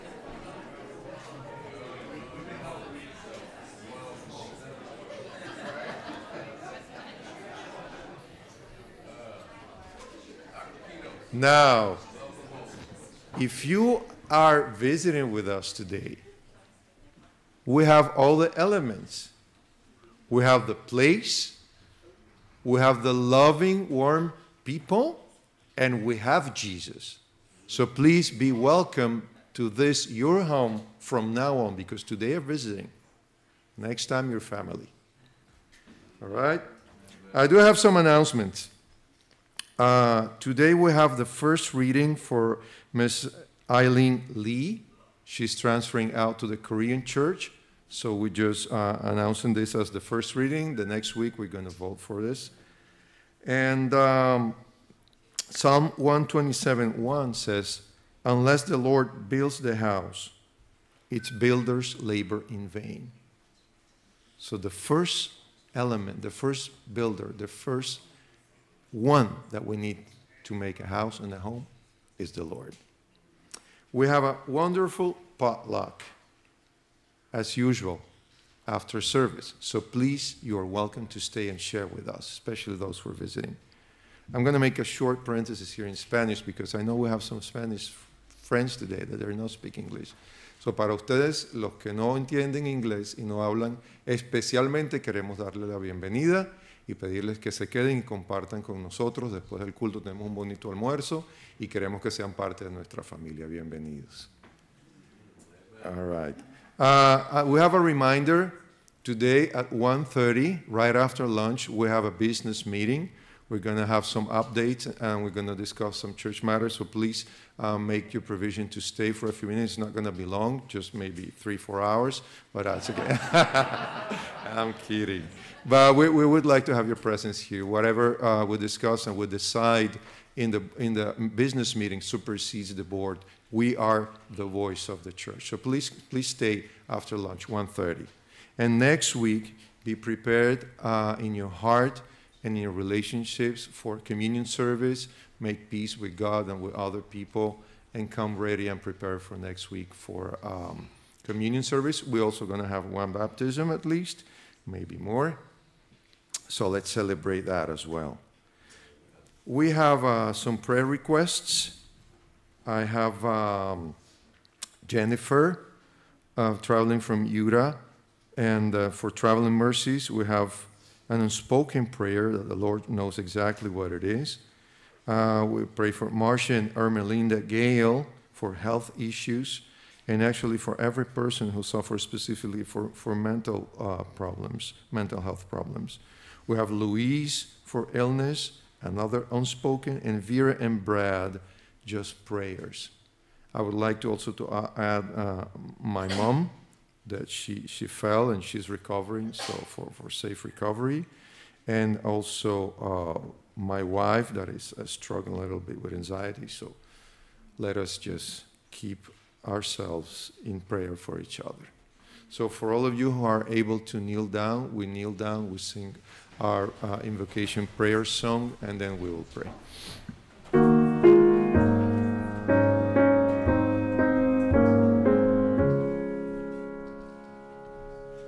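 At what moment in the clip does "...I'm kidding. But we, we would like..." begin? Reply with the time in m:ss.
2:04.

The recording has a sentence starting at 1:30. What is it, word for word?
So para ustedes, los que no entienden inglés y no hablan, especialmente queremos darle la bienvenida.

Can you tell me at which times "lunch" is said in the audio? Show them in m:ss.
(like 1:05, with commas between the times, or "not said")
1:51, 2:17.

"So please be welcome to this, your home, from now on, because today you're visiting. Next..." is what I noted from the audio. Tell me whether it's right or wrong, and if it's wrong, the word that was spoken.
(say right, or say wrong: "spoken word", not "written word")
right.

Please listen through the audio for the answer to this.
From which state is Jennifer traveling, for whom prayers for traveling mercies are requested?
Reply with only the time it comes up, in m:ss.
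2:47.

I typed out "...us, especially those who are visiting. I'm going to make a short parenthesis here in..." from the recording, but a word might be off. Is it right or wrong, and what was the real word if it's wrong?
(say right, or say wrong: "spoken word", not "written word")
right.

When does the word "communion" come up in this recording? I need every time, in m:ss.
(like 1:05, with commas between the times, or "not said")
2:23, 2:31.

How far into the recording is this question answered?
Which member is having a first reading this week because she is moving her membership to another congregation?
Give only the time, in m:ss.
0:42.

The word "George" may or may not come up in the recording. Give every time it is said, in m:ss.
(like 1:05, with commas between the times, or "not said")
not said.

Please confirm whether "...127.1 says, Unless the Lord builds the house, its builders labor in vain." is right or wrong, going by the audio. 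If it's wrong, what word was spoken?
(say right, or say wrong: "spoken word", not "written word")
right.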